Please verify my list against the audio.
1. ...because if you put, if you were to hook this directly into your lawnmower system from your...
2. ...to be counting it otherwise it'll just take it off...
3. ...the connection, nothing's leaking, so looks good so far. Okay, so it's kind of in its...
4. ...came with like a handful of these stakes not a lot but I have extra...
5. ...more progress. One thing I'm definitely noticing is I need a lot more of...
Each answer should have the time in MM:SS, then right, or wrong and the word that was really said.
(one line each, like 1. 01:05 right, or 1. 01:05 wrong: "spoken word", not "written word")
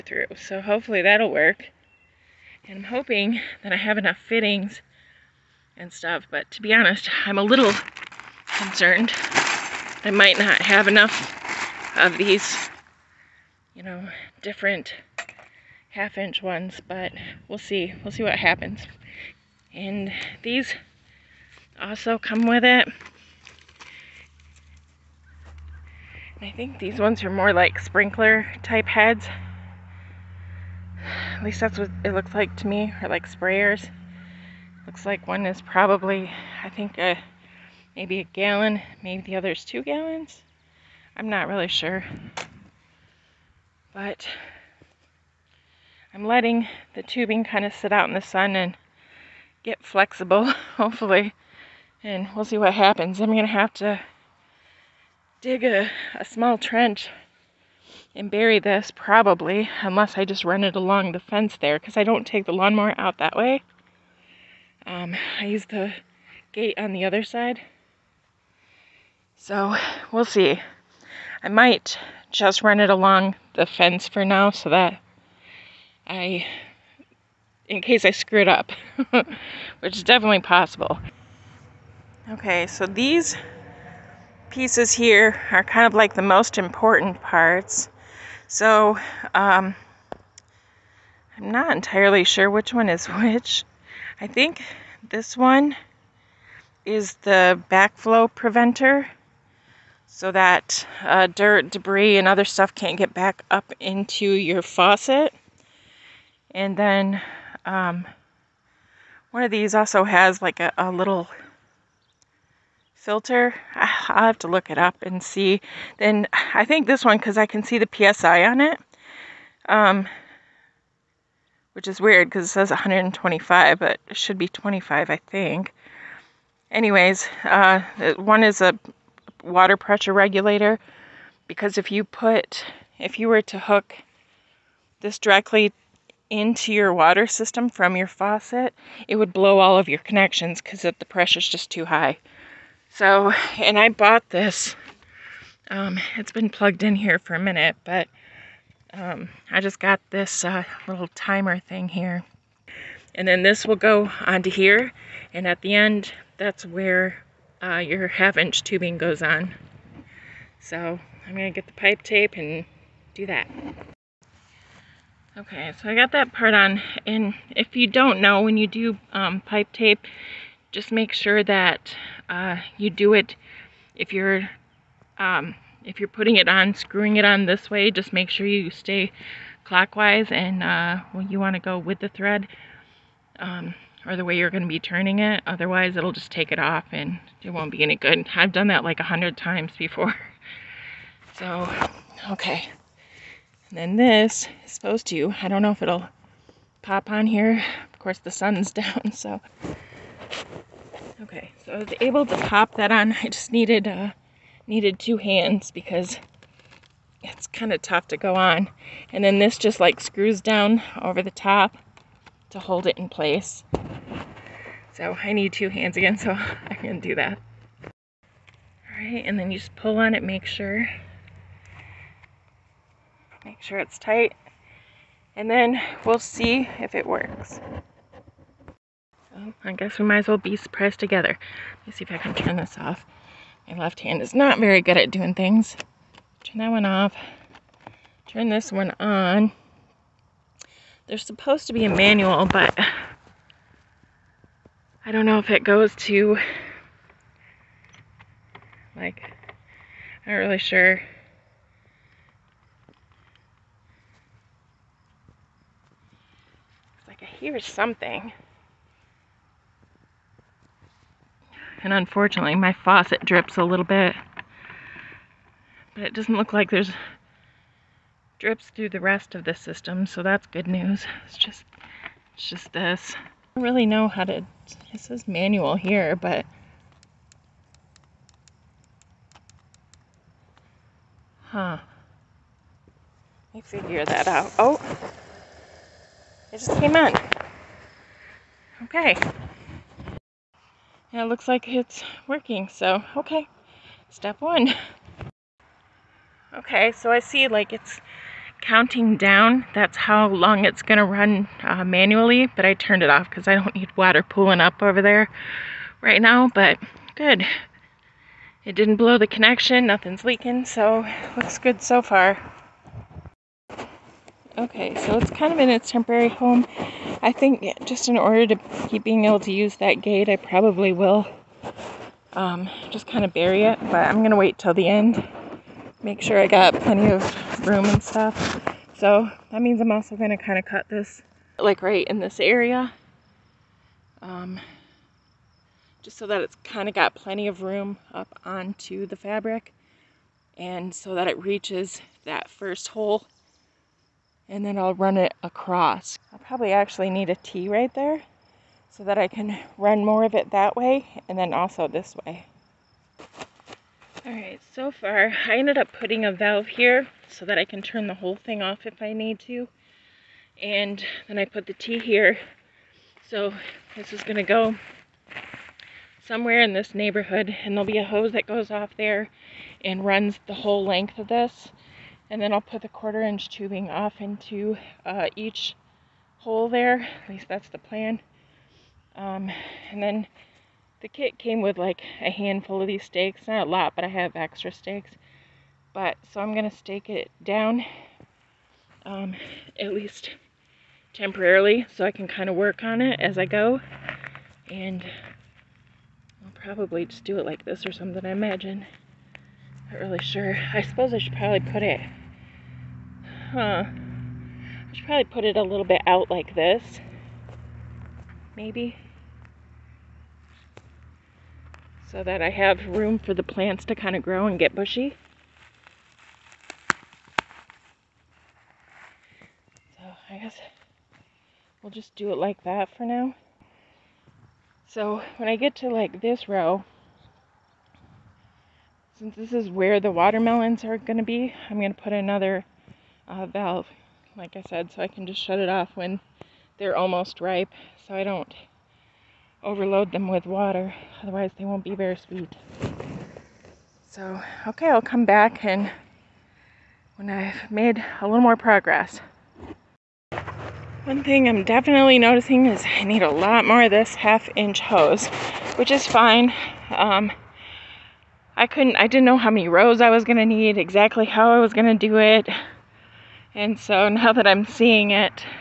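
1. 02:11 wrong: "water", not "lawnmower"
2. 03:04 wrong: "turning", not "counting"
3. 05:09 right
4. 06:21 right
5. 07:28 right.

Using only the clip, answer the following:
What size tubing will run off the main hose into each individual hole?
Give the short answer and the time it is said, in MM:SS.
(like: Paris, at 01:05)
Quarter inch, at 06:12.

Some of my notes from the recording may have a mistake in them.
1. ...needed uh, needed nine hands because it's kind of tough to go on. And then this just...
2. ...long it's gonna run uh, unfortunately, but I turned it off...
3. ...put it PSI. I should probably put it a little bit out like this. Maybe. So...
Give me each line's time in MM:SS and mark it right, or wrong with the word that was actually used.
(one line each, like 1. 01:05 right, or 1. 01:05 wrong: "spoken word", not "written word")
1. 03:23 wrong: "two", not "nine"
2. 05:00 wrong: "manually", not "unfortunately"
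3. 06:41 wrong: "Huh", not "PSI".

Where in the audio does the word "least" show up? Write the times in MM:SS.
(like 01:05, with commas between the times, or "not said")
00:31, 06:17, 06:29.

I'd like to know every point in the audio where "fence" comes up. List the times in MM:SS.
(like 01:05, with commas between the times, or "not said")
01:01, 01:13.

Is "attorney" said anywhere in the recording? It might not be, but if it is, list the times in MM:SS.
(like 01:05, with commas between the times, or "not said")
not said.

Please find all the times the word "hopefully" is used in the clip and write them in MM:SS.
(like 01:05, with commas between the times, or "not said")
00:00, 00:50.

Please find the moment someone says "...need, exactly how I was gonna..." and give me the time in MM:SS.
07:40.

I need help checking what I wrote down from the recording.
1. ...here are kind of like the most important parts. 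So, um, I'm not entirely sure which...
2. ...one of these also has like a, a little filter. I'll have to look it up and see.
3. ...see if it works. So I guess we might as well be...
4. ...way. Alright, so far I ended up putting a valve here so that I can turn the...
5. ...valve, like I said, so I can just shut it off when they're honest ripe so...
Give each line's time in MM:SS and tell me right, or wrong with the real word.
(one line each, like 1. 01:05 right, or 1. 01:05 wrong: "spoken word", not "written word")
1. 01:24 right
2. 01:49 right
3. 03:46 right
4. 05:52 right
5. 07:13 wrong: "almost", not "honest".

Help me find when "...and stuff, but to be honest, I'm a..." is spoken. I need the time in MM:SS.
00:05.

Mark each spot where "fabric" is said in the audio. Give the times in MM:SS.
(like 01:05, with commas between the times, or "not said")
05:39.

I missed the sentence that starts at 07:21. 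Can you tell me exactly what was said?
Otherwise, they won't be very sweet.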